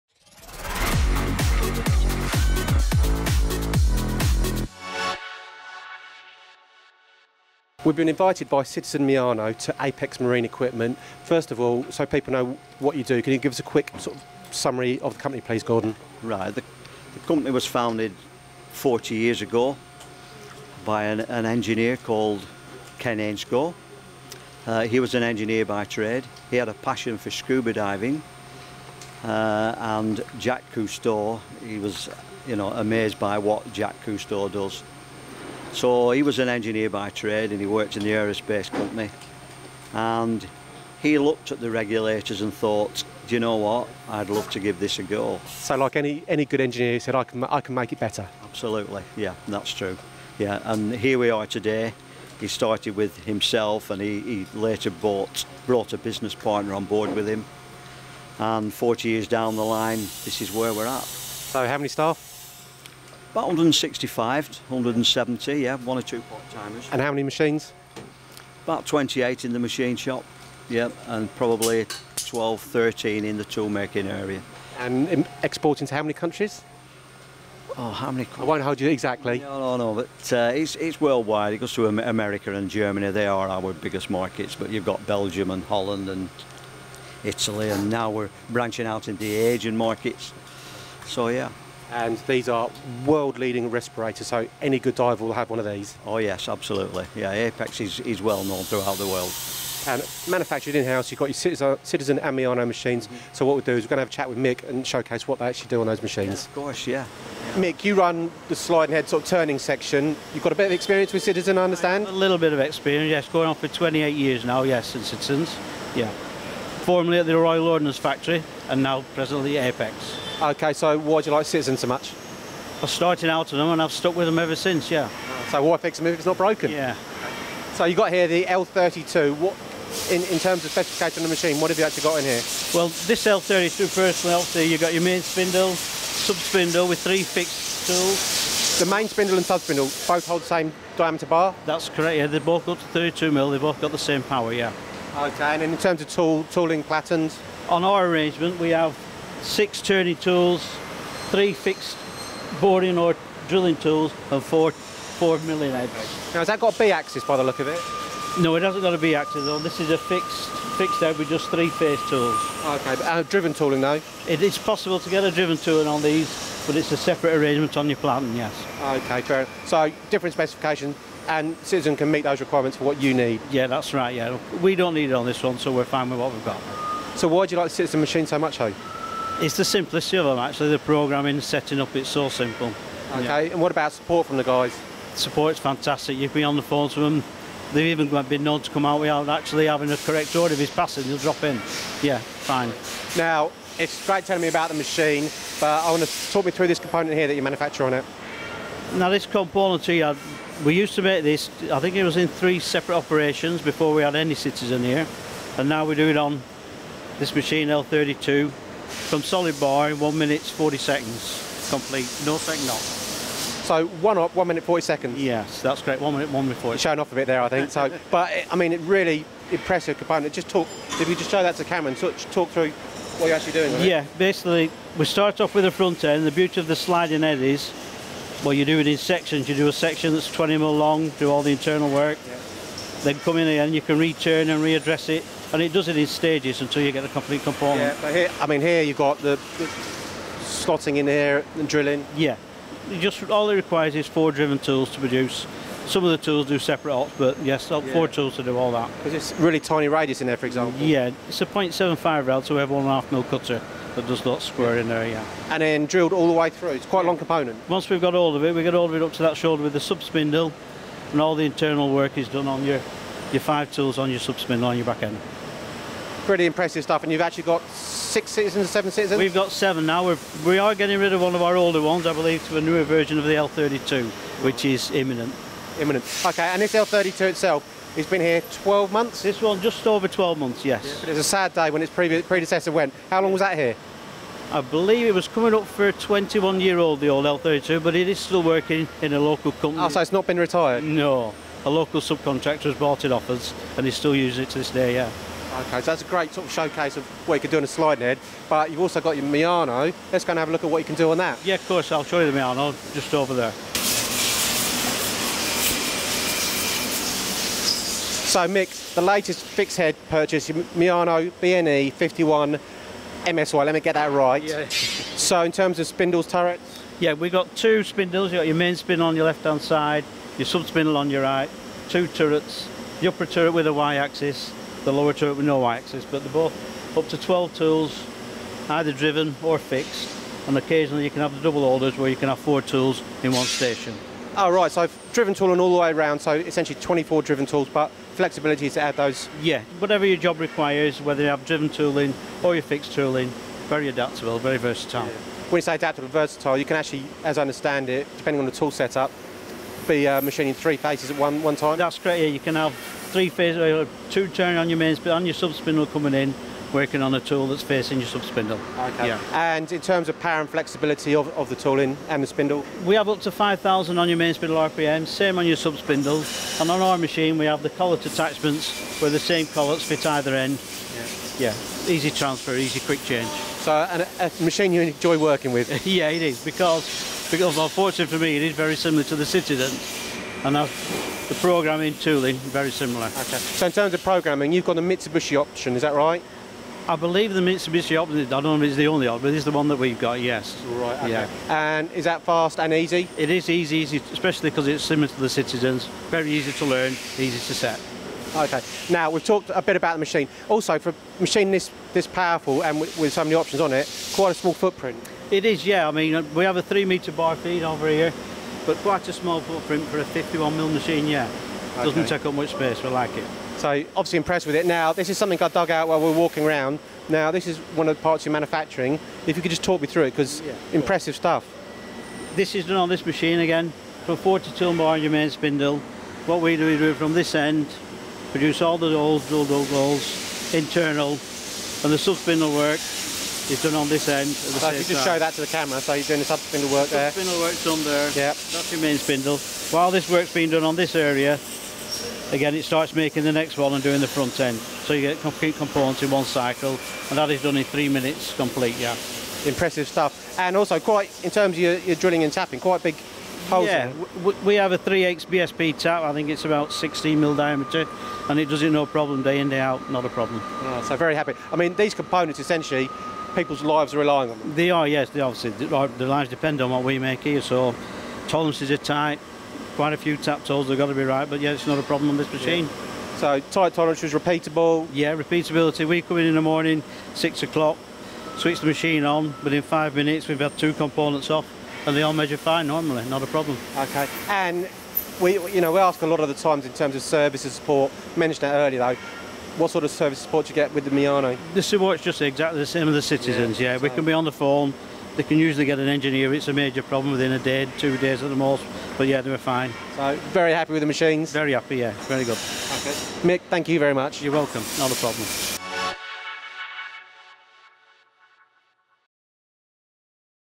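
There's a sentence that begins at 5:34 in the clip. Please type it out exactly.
Oh right, so driven tooling all the way around, so essentially 24 driven tools, but flexibility to add those?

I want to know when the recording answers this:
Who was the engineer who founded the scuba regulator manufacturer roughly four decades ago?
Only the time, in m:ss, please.
0:22.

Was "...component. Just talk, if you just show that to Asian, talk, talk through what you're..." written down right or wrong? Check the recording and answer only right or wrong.
wrong.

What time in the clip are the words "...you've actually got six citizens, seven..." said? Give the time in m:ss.
4:27.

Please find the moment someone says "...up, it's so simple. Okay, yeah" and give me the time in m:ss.
3:01.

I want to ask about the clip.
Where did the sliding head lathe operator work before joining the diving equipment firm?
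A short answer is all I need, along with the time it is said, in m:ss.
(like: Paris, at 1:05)
Royal Ordnance Factory, at 1:57.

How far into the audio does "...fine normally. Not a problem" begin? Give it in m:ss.
8:02.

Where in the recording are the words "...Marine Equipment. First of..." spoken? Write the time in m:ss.
0:10.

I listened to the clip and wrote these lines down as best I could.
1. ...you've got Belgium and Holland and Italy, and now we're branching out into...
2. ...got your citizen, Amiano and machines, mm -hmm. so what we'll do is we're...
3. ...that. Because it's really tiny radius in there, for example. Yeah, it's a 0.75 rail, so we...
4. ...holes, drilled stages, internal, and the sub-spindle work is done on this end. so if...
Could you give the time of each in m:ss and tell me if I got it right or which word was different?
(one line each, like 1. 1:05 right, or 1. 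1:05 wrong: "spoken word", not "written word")
1. 1:24 right
2. 1:41 right
3. 4:08 right
4. 7:08 wrong: "holes", not "stages".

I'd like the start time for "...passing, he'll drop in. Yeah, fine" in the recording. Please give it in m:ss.
3:10.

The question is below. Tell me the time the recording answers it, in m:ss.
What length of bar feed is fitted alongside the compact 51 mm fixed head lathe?
6:46.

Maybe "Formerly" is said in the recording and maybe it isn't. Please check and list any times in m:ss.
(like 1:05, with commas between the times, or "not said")
1:56.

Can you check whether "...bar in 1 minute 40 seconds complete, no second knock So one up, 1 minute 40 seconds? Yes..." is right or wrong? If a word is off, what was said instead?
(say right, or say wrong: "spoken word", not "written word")
right.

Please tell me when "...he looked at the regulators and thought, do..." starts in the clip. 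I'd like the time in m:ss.
0:41.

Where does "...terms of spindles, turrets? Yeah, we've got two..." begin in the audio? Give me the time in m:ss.
5:15.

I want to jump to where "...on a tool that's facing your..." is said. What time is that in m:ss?
5:57.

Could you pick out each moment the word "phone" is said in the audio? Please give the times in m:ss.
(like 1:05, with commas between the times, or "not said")
3:06, 8:14.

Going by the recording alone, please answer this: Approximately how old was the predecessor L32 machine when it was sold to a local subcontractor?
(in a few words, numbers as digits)
21 years.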